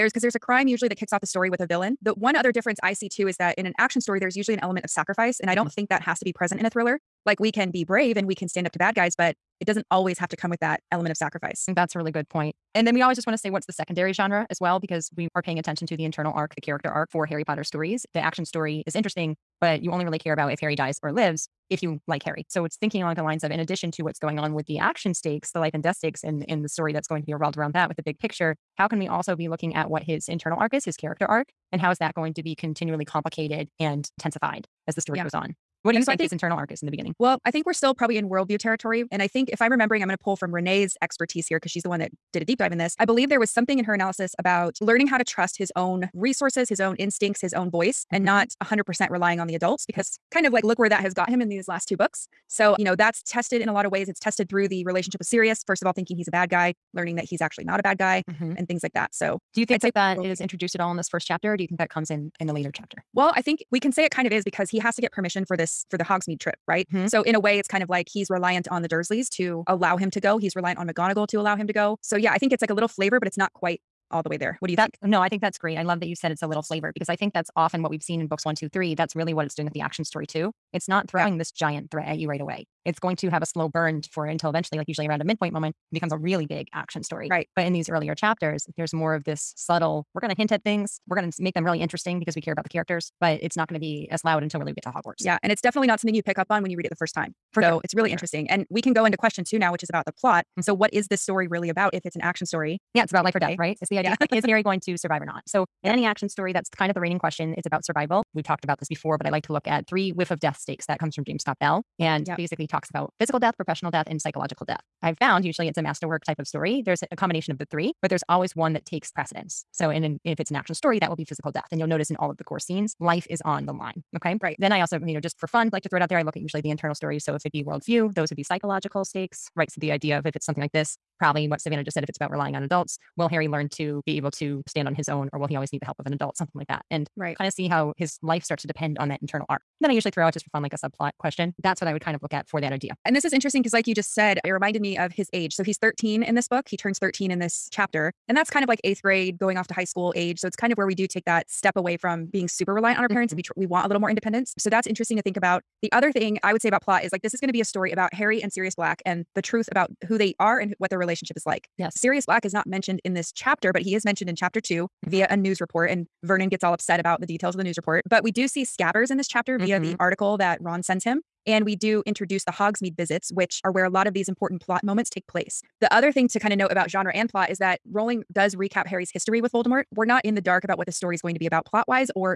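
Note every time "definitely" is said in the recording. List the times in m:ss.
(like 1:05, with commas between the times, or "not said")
1:35.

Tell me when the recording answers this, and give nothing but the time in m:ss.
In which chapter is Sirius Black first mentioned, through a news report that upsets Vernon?
2:44.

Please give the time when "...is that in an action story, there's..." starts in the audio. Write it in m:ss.
0:03.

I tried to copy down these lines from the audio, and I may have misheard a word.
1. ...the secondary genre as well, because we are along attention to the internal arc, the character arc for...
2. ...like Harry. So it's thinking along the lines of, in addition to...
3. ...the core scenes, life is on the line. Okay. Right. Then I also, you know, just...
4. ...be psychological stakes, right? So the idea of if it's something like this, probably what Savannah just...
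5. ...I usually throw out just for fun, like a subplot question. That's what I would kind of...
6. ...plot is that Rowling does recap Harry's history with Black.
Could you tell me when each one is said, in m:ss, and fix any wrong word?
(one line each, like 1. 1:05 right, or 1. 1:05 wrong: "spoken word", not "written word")
1. 0:13 wrong: "paying", not "along"
2. 0:22 right
3. 2:02 right
4. 2:08 right
5. 2:19 right
6. 2:57 wrong: "Voldemort", not "Black".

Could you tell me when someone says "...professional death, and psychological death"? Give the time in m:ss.
1:53.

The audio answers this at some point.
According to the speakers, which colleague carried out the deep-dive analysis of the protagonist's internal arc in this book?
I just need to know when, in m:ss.
0:40.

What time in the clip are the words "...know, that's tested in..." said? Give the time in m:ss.
0:52.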